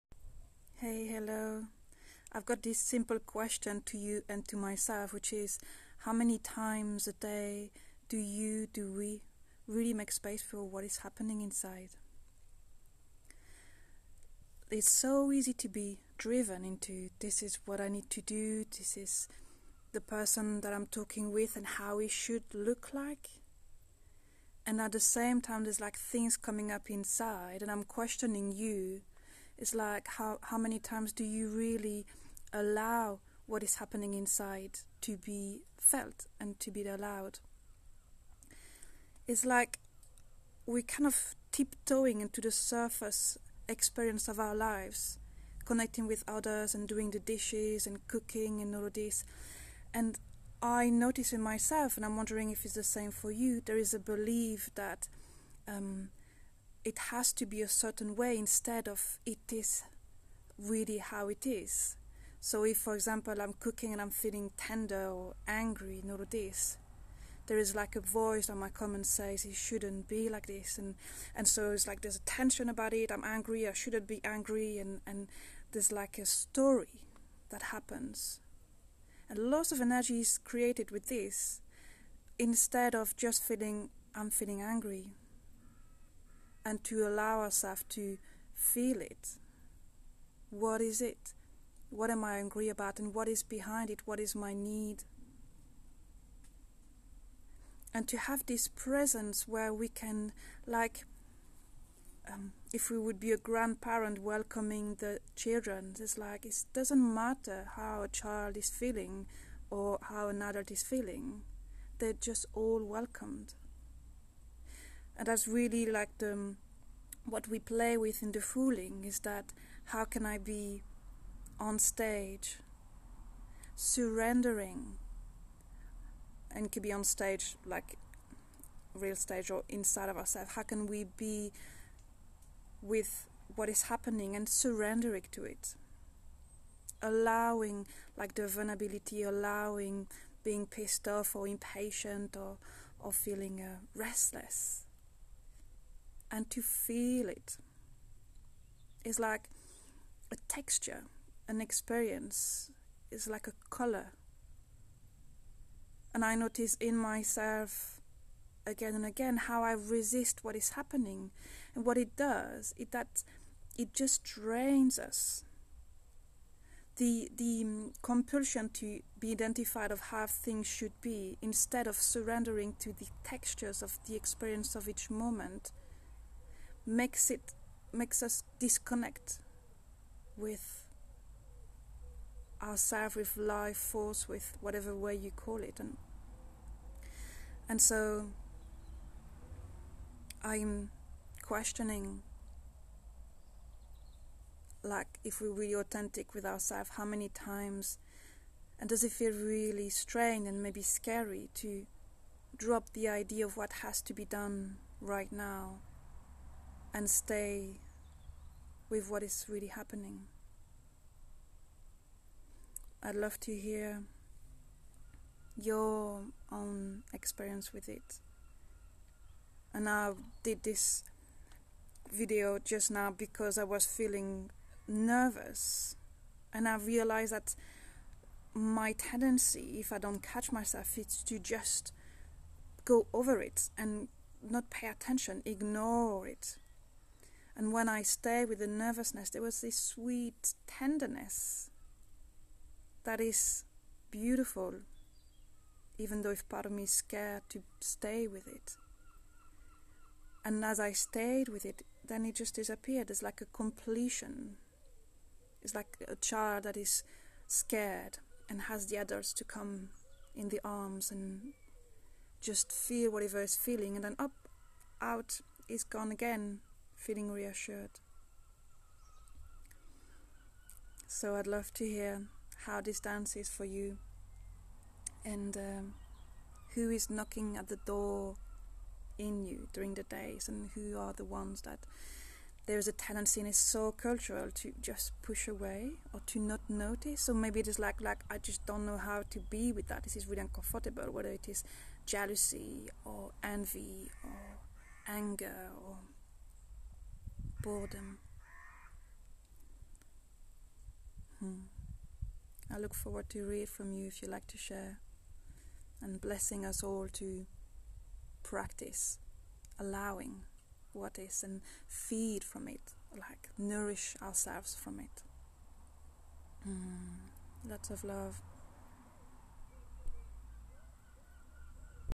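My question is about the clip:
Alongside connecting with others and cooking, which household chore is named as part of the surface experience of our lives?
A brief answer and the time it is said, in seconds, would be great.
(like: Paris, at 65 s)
doing the dishes, at 46 s.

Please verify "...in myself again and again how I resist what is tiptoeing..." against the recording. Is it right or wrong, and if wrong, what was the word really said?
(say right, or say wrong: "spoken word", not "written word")
wrong: "happening", not "tiptoeing".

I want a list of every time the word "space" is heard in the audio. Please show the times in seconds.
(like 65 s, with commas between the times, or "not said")
10 s.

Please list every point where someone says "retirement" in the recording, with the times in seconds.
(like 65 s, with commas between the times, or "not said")
not said.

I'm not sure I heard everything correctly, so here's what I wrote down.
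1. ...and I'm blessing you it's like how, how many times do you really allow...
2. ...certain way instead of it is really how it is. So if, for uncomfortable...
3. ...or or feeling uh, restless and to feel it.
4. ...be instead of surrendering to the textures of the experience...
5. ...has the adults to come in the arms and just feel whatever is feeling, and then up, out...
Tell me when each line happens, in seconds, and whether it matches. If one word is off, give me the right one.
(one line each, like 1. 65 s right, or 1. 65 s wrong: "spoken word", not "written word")
1. 27 s wrong: "questioning", not "blessing"
2. 57 s wrong: "example", not "uncomfortable"
3. 142 s right
4. 171 s right
5. 258 s right.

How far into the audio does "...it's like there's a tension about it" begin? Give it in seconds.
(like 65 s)
71 s.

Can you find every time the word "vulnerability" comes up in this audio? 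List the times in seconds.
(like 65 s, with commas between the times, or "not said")
138 s.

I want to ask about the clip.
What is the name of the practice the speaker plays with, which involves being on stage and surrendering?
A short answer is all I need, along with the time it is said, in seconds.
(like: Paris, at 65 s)
fooling, at 118 s.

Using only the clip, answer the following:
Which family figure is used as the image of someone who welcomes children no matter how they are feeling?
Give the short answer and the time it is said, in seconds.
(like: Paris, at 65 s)
grandparent, at 103 s.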